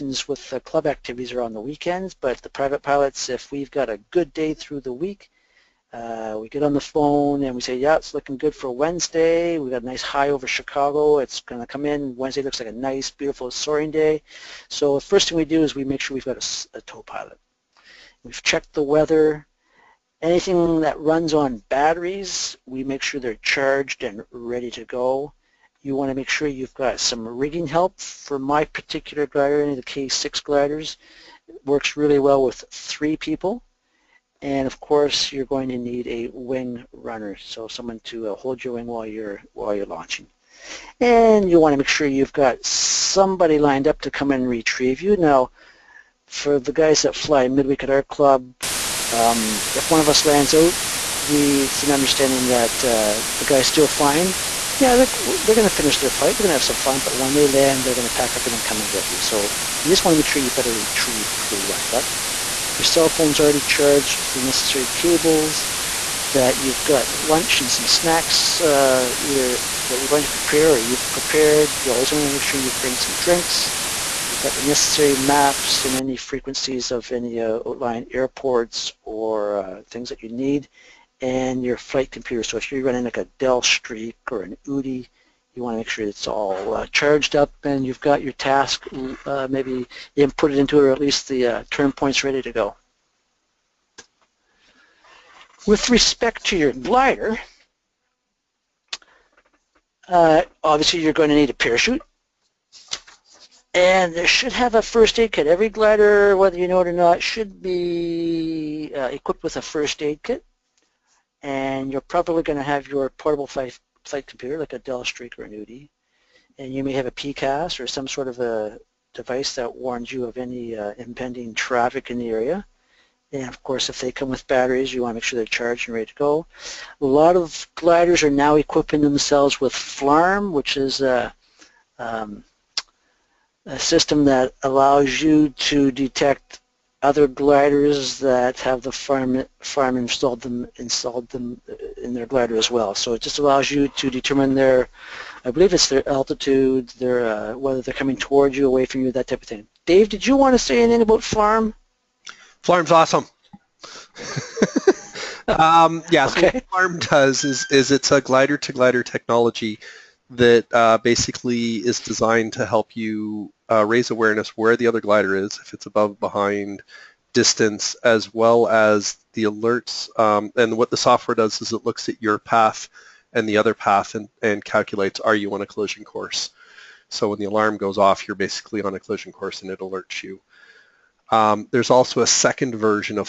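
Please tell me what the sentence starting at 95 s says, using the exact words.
With respect to your glider, uh, obviously you're going to need a parachute and there should have a first aid kit.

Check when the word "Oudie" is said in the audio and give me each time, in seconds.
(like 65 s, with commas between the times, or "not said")
84 s, 115 s.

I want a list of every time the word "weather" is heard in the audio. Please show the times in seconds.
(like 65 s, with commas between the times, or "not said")
18 s.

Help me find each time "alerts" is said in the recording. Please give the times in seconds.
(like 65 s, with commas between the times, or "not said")
169 s, 179 s.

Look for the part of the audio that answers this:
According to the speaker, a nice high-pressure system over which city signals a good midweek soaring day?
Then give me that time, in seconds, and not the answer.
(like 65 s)
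10 s.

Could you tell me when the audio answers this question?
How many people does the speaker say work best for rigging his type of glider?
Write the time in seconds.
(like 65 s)
32 s.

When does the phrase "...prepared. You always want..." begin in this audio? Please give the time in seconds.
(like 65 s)
71 s.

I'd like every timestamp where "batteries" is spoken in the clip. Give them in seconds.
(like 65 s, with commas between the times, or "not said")
21 s, 124 s.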